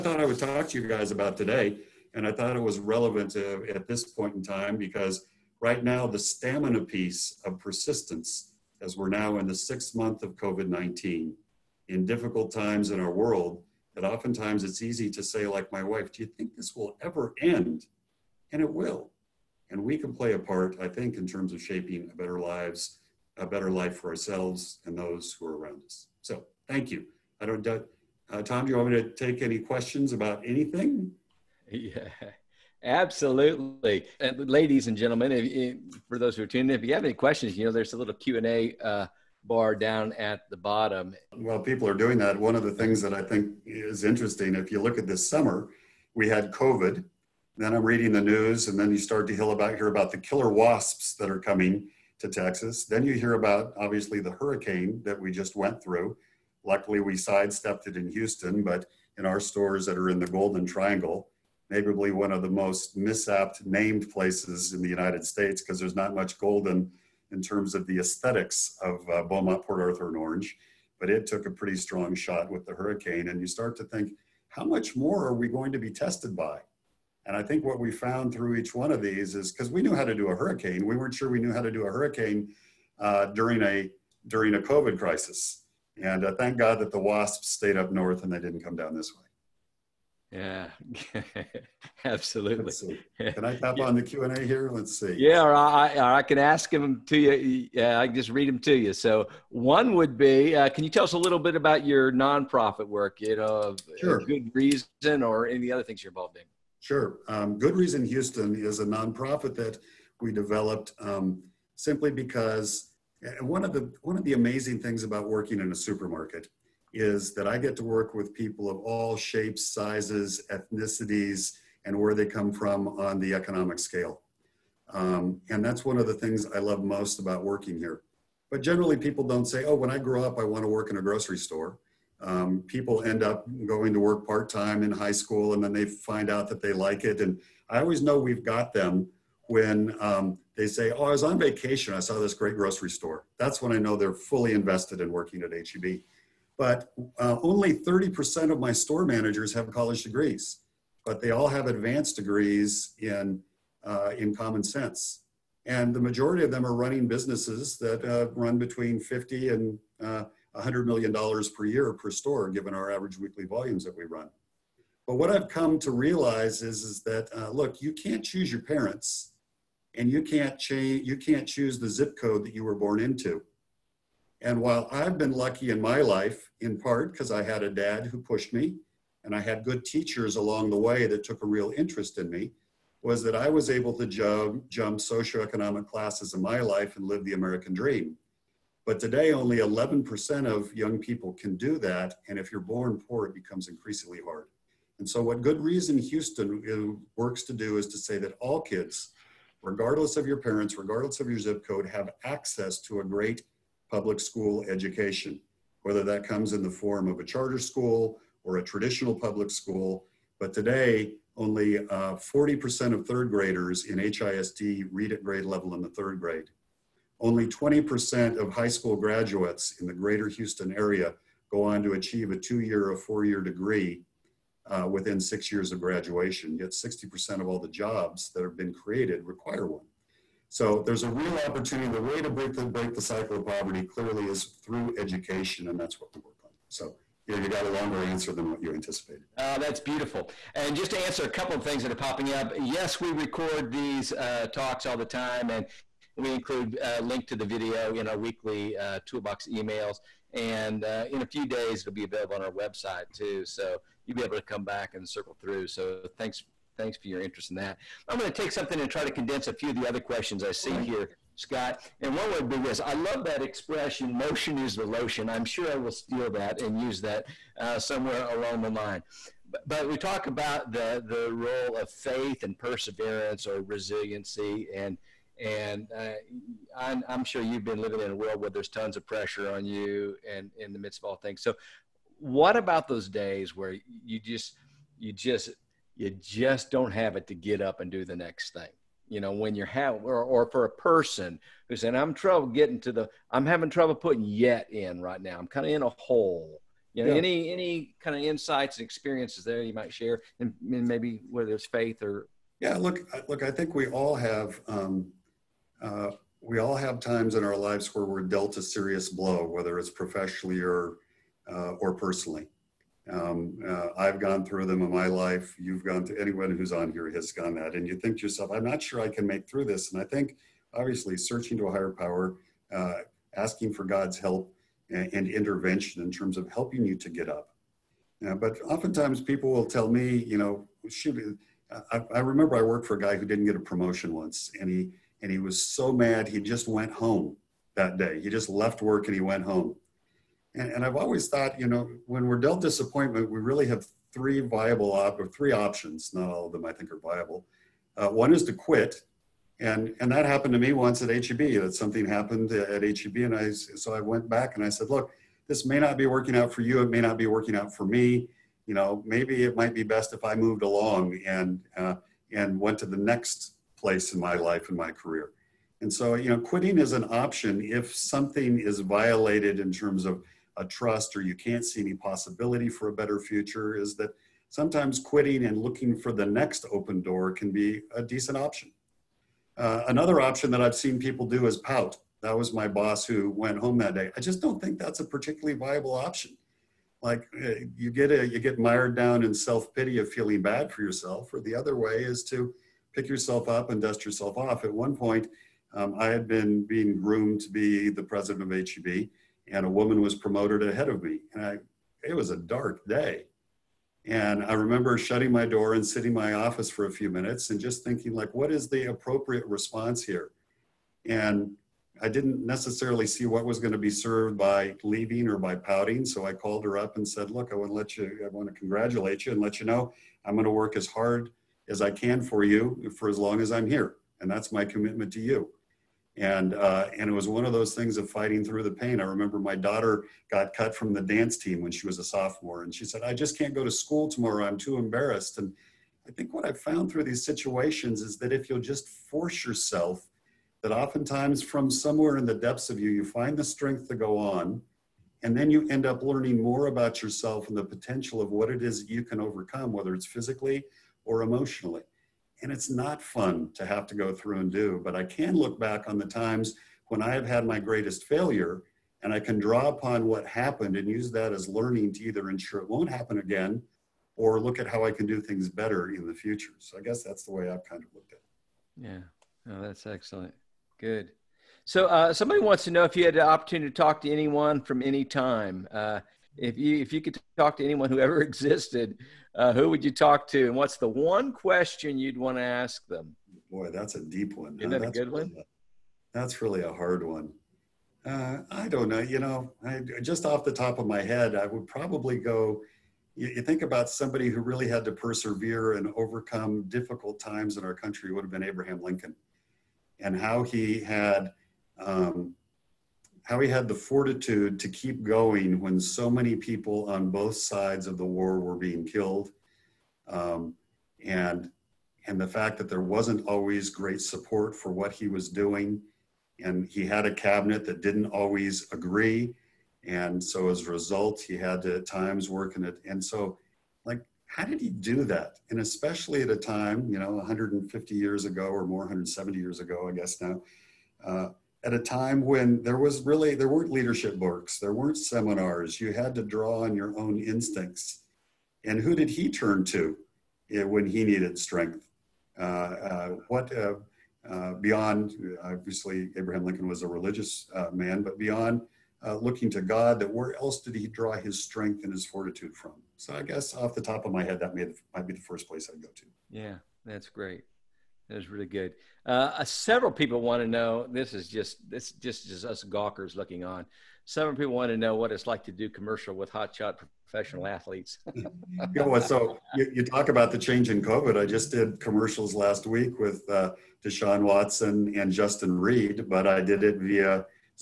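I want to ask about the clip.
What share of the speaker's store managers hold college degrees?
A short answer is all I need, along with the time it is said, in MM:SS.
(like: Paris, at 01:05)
30%, at 02:27.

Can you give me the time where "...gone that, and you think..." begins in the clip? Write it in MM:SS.
05:17.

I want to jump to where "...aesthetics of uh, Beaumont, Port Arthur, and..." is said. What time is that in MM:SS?
01:07.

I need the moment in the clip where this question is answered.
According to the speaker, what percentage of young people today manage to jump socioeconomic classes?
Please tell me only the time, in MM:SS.
03:09.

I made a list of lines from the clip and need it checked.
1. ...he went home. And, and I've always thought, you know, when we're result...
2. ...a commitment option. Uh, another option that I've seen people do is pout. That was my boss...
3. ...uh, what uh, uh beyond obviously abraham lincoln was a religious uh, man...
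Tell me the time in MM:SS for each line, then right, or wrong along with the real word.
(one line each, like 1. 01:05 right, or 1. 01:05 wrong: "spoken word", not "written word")
1. 05:39 wrong: "dealt", not "result"
2. 06:17 wrong: "decent", not "commitment"
3. 09:02 right.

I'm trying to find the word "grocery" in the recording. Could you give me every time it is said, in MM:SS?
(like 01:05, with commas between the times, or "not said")
02:11, 02:22.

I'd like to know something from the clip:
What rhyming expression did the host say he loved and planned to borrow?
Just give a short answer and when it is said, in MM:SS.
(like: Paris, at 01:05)
Motion is the lotion, at 04:24.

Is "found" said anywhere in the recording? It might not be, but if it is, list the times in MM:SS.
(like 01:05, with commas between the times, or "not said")
01:17, 07:16.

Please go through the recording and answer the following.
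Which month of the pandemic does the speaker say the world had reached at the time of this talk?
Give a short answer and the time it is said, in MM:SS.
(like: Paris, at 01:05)
sixth, at 00:09.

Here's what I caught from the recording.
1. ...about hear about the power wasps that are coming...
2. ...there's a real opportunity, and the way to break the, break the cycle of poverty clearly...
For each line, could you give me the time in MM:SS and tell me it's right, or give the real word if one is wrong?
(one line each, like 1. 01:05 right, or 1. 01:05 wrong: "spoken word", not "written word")
1. 00:49 wrong: "killer", not "power"
2. 03:50 right.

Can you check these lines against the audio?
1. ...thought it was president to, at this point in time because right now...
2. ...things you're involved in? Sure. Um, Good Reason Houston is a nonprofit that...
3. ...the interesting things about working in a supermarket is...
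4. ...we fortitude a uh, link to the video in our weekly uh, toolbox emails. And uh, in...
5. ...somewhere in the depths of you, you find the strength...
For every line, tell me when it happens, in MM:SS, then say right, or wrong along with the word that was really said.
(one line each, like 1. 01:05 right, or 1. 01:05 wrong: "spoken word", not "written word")
1. 00:02 wrong: "relevant", not "president"
2. 01:45 right
3. 01:54 wrong: "amazing", not "interesting"
4. 04:06 wrong: "include", not "fortitude"
5. 07:21 right.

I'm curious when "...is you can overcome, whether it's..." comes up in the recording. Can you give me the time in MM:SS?
07:28.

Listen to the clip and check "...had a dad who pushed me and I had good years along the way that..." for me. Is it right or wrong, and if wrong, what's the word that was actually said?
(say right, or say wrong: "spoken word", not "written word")
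wrong: "teachers", not "years".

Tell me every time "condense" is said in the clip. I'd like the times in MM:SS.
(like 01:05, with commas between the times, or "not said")
04:19.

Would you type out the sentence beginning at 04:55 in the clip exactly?
I'm kind of in a hole." You know, yeah.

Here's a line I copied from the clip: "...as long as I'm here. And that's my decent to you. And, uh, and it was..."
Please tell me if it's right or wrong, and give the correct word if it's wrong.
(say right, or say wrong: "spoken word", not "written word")
wrong: "commitment", not "decent".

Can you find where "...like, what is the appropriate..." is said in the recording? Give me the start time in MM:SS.
06:48.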